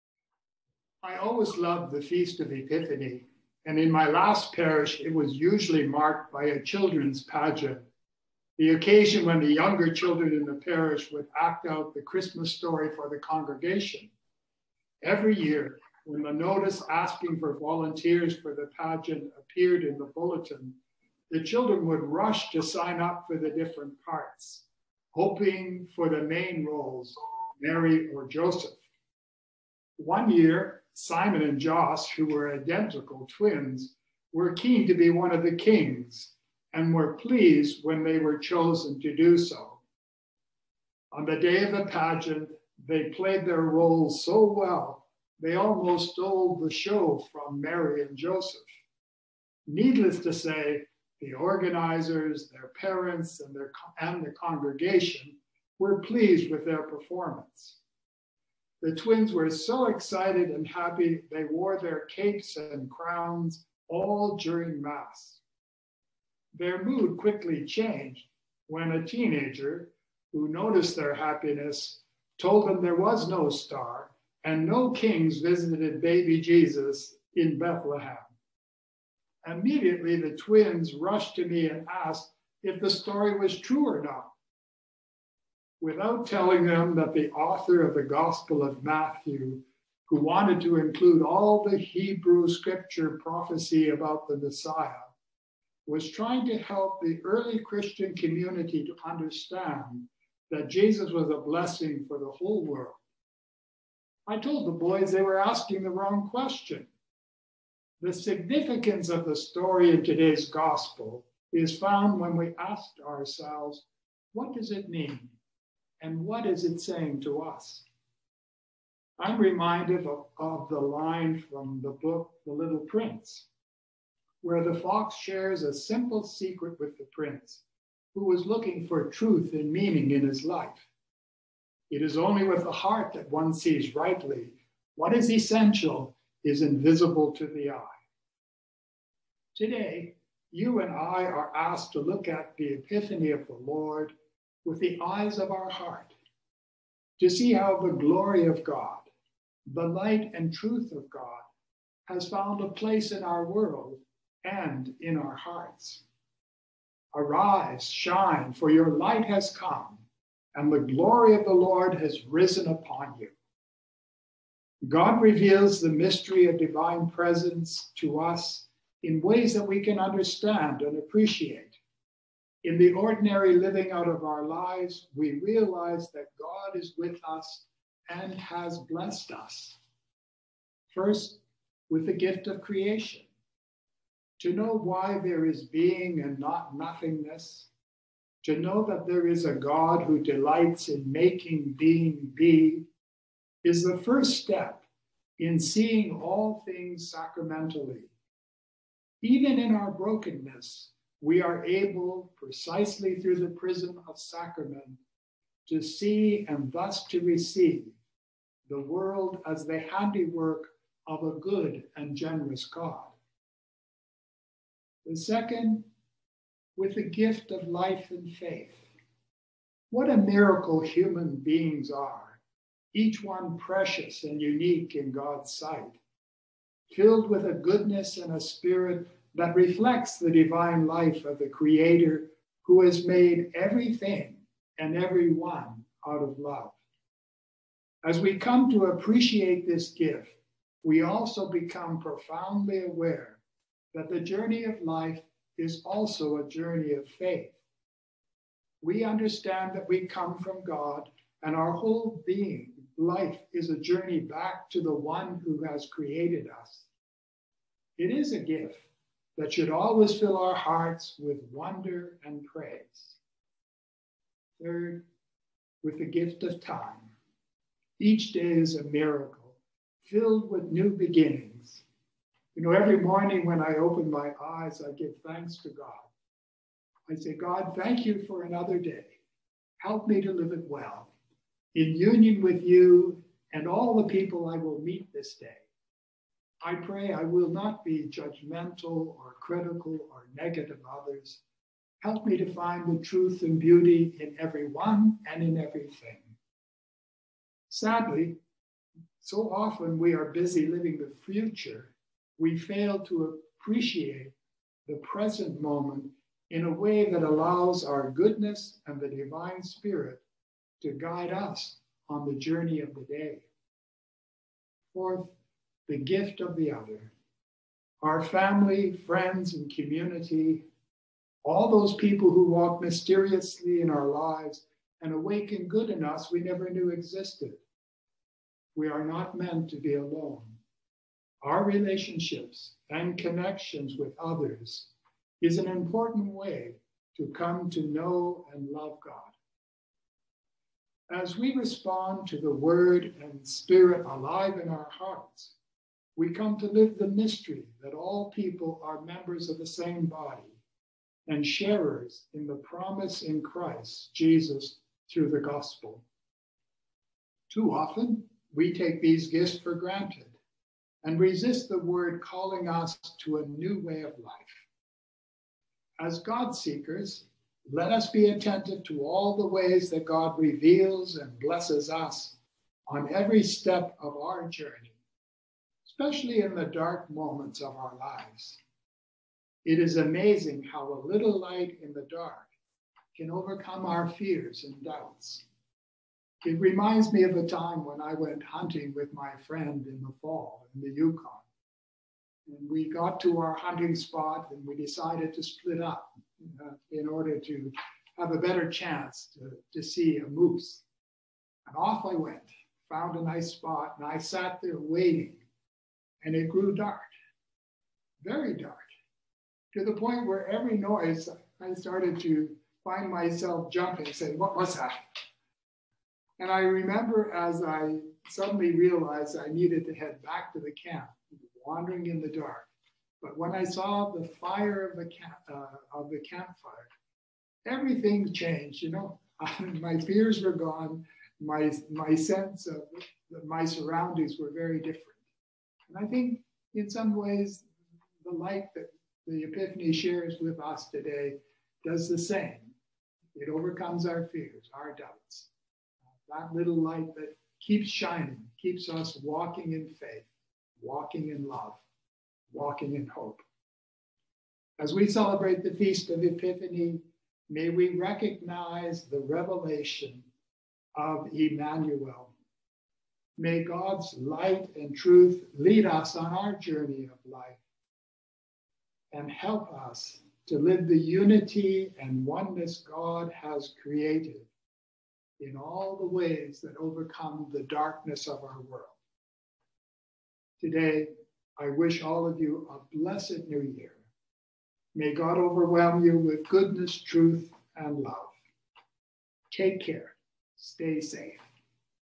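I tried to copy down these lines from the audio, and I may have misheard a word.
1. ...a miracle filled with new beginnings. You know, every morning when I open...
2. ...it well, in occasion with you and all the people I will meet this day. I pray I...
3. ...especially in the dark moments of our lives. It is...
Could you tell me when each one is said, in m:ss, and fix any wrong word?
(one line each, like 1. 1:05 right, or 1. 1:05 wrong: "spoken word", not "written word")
1. 4:28 right
2. 4:40 wrong: "union", not "occasion"
3. 6:16 right.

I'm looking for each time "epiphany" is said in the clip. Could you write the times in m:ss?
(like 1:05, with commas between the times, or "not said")
0:02, 2:22, 7:19, 7:36.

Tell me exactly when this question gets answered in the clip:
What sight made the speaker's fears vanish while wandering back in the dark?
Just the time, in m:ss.
7:06.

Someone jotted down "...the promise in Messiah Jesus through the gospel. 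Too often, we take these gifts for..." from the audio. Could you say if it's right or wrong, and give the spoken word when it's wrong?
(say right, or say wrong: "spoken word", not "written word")
wrong: "Christ", not "Messiah".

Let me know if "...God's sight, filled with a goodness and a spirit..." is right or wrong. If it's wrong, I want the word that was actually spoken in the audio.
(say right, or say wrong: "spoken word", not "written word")
right.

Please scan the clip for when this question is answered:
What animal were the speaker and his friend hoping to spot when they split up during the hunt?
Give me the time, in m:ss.
6:40.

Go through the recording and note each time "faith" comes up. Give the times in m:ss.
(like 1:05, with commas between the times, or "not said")
3:38, 4:07, 7:29.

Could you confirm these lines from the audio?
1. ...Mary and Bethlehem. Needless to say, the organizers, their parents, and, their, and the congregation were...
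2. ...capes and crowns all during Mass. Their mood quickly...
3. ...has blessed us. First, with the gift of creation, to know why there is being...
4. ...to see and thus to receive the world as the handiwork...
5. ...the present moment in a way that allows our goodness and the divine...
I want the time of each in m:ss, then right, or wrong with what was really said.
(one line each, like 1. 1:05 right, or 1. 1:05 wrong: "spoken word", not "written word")
1. 0:47 wrong: "Joseph", not "Bethlehem"
2. 1:02 right
3. 2:58 right
4. 3:25 right
5. 5:04 right.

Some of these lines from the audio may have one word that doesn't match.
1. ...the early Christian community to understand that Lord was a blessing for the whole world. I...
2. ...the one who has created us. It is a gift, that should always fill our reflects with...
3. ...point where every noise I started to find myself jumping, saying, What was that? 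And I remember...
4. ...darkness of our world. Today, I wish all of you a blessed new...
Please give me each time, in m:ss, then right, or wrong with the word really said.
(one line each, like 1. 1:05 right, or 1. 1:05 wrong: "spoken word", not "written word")
1. 1:37 wrong: "Jesus", not "Lord"
2. 4:14 wrong: "hearts", not "reflects"
3. 6:49 right
4. 7:57 right.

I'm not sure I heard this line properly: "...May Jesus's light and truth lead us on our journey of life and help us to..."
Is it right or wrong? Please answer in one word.
wrong.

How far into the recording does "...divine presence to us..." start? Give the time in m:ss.
2:46.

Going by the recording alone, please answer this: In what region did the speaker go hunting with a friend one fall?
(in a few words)
The Yukon.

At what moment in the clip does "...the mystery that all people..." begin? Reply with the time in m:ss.
5:46.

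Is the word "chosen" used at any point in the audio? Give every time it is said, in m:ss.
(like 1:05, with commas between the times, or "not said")
0:38.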